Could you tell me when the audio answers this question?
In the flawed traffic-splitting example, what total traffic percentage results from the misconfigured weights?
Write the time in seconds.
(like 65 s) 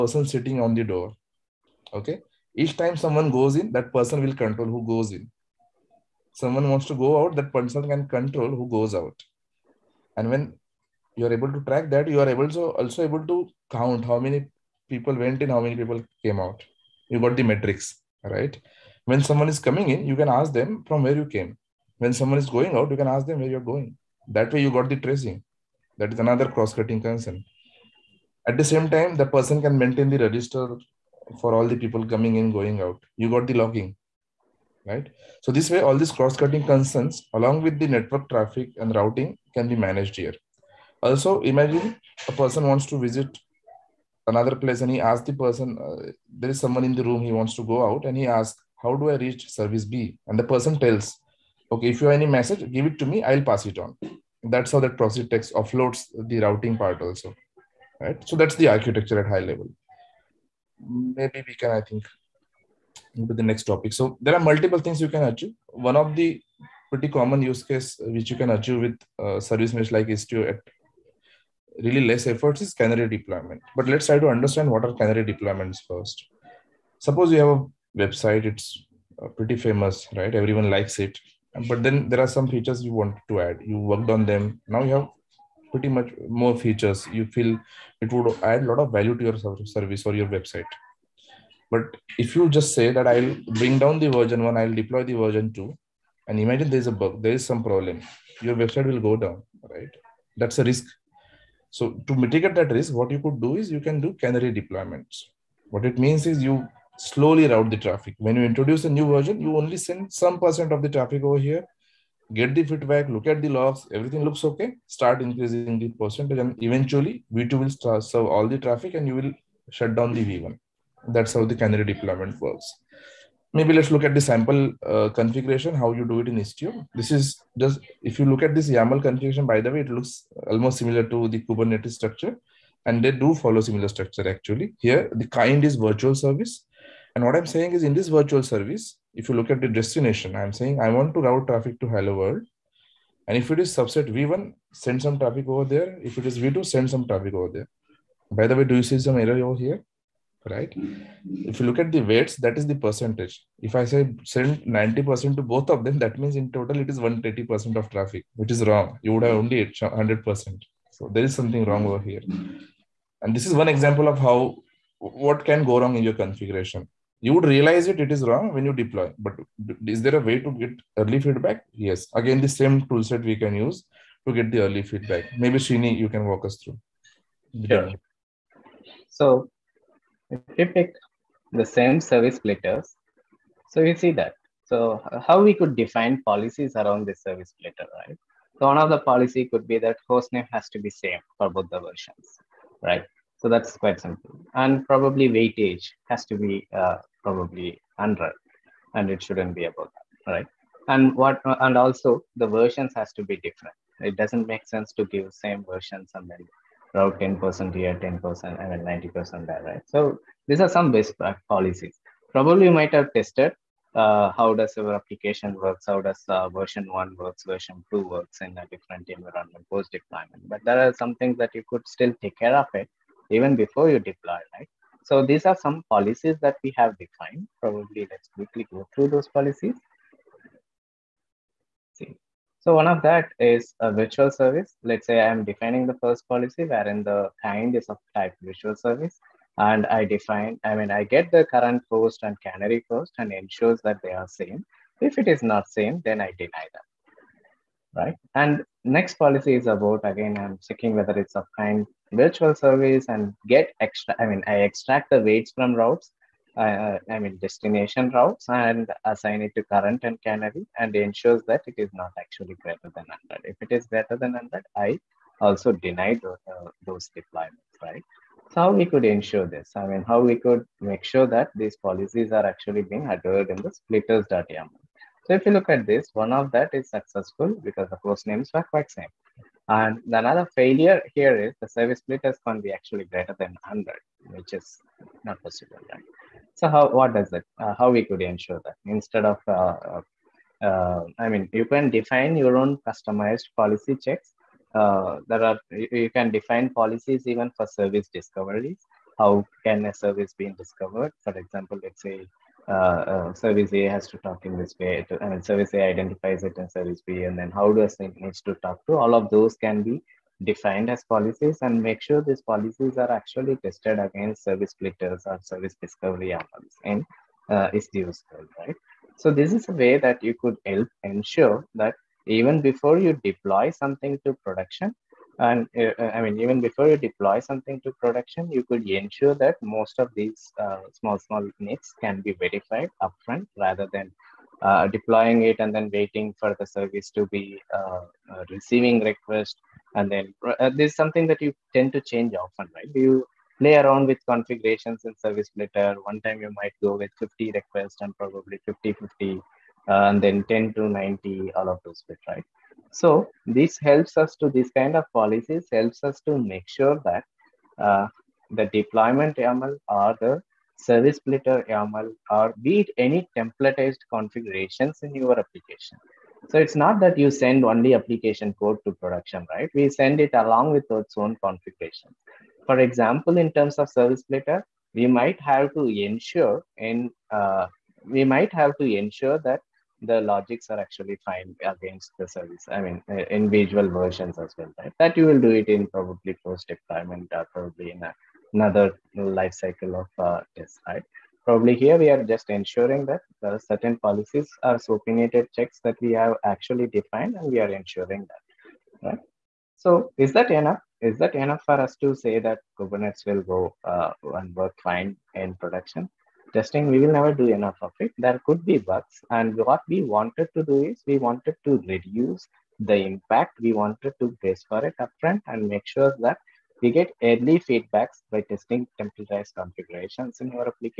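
156 s.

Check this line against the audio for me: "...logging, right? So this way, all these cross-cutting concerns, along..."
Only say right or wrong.
right.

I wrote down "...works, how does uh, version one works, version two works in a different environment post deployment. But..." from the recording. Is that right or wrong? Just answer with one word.
right.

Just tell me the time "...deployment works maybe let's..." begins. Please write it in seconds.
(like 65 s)
121 s.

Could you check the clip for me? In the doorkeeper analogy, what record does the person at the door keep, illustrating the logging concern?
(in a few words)
Register.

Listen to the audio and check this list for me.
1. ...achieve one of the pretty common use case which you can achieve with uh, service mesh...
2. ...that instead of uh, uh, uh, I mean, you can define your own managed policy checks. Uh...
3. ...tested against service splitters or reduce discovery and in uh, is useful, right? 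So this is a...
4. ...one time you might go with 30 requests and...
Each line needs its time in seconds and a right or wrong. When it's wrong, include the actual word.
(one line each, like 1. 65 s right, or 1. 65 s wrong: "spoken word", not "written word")
1. 65 s right
2. 288 s wrong: "customized", not "managed"
3. 313 s wrong: "service", not "reduce"
4. 346 s wrong: "50", not "30".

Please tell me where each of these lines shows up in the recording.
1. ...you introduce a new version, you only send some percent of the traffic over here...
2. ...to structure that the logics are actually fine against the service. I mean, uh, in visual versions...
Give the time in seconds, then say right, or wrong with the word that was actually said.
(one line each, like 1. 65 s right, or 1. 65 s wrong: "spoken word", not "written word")
1. 108 s right
2. 378 s wrong: "ensure", not "structure".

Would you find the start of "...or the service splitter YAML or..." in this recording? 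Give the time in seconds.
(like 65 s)
359 s.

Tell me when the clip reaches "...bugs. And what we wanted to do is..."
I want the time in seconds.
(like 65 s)
408 s.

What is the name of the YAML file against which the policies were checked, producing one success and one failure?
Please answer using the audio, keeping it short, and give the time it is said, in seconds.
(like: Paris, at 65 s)
splitters.yaml, at 273 s.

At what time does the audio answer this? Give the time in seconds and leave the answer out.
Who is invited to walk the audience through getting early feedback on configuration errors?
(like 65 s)
175 s.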